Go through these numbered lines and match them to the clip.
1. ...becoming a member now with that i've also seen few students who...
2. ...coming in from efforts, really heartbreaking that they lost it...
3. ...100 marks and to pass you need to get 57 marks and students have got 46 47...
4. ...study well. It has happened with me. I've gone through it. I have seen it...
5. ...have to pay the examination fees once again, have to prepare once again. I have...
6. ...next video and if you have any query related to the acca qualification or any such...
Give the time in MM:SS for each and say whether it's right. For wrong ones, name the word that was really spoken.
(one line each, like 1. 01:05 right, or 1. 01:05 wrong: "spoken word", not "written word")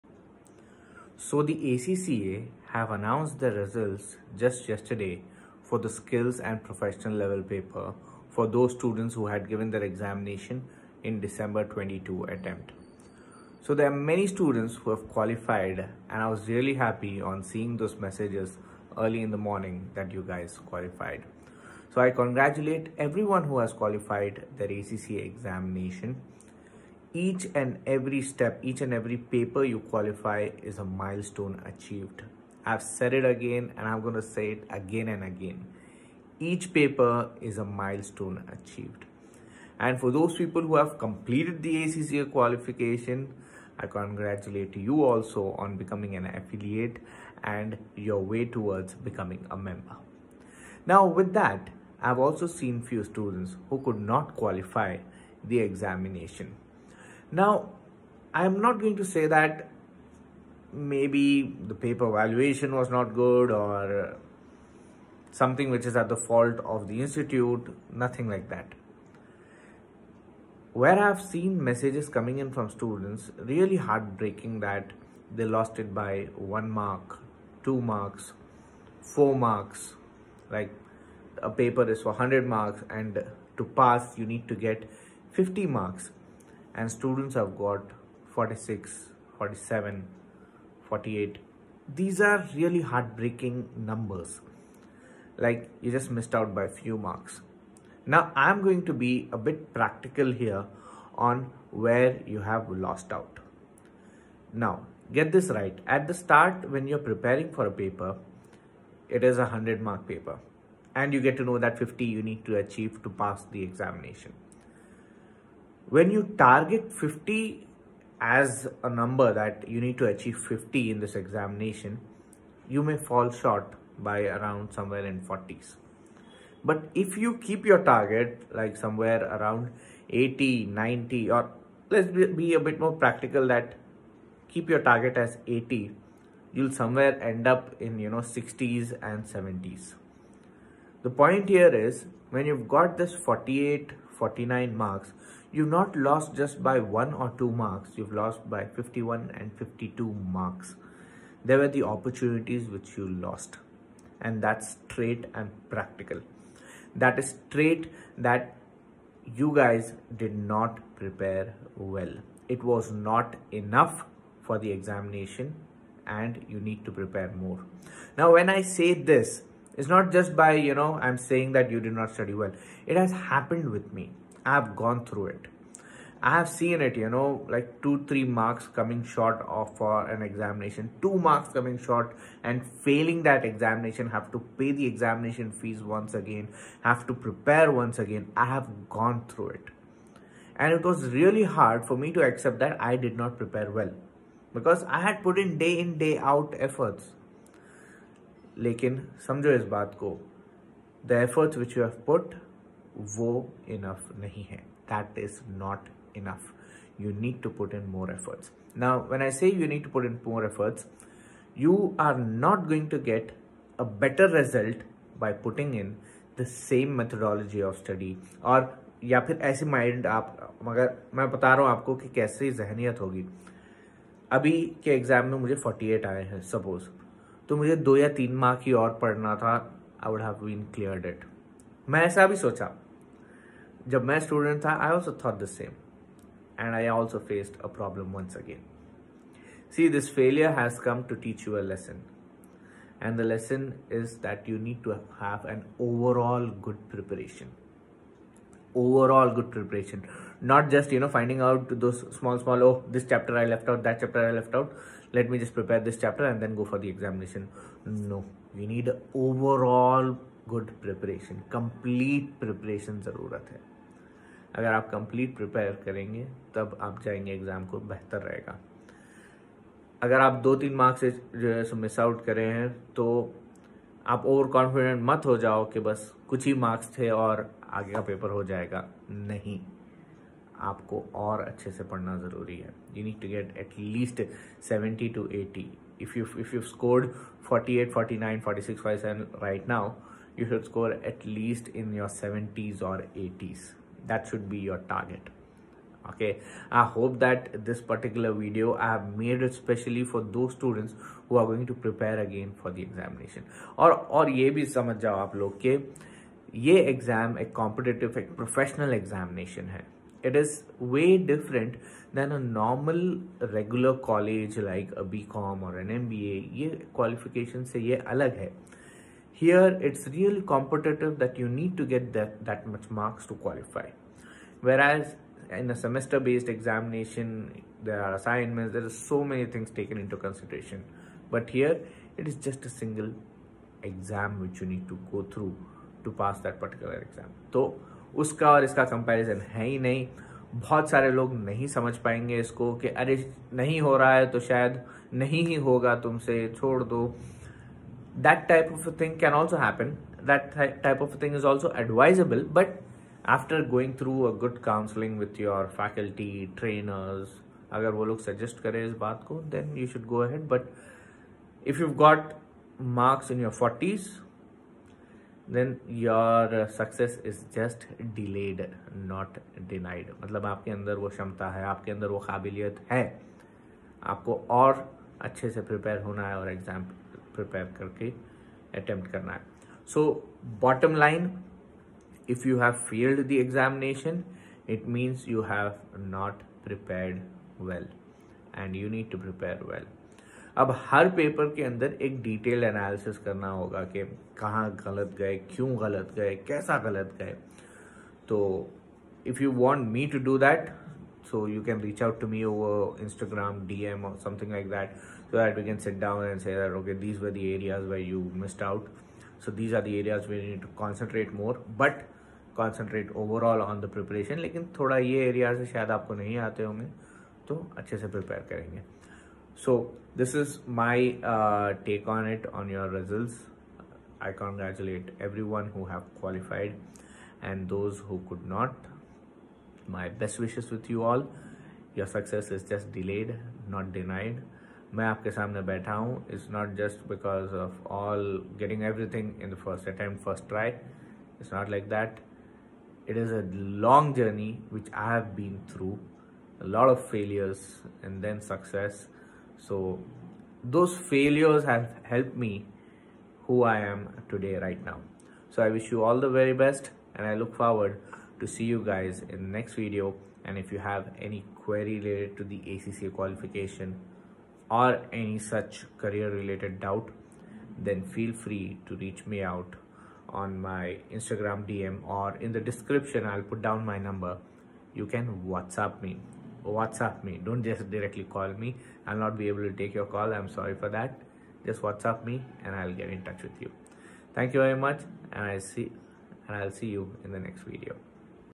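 1. 00:48 right
2. 01:12 wrong: "students", not "efforts"
3. 01:22 wrong: "50", not "57"
4. 02:52 right
5. 03:04 right
6. 07:39 right.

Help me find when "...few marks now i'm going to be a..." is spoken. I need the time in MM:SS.
01:36.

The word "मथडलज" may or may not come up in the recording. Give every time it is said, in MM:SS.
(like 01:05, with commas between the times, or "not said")
03:36.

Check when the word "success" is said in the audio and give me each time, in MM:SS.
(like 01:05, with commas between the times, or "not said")
06:06, 07:12, 07:28.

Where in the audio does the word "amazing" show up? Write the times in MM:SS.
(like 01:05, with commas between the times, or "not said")
not said.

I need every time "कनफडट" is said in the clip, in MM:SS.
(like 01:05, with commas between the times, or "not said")
04:34.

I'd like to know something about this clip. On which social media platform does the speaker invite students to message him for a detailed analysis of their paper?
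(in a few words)
Instagram.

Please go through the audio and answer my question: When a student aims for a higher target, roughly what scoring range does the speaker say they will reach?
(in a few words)
60s and 70s.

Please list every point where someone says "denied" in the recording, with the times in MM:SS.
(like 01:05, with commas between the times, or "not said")
06:09, 07:13.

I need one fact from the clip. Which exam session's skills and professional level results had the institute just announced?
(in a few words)
December 22.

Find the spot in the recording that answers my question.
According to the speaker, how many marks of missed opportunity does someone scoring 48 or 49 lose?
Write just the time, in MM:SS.
02:28.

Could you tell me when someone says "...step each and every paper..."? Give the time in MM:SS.
00:28.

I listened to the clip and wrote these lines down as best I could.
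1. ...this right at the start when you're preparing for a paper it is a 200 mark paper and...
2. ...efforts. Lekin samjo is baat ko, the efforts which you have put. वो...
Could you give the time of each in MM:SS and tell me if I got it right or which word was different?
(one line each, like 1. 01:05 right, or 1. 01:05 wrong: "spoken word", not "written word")
1. 01:45 wrong: "100", not "200"
2. 03:16 right.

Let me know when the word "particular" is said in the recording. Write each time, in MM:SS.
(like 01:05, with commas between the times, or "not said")
04:57, 05:36.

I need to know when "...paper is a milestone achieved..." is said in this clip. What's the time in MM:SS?
00:36.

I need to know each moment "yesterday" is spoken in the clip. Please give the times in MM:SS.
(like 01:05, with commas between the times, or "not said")
00:04.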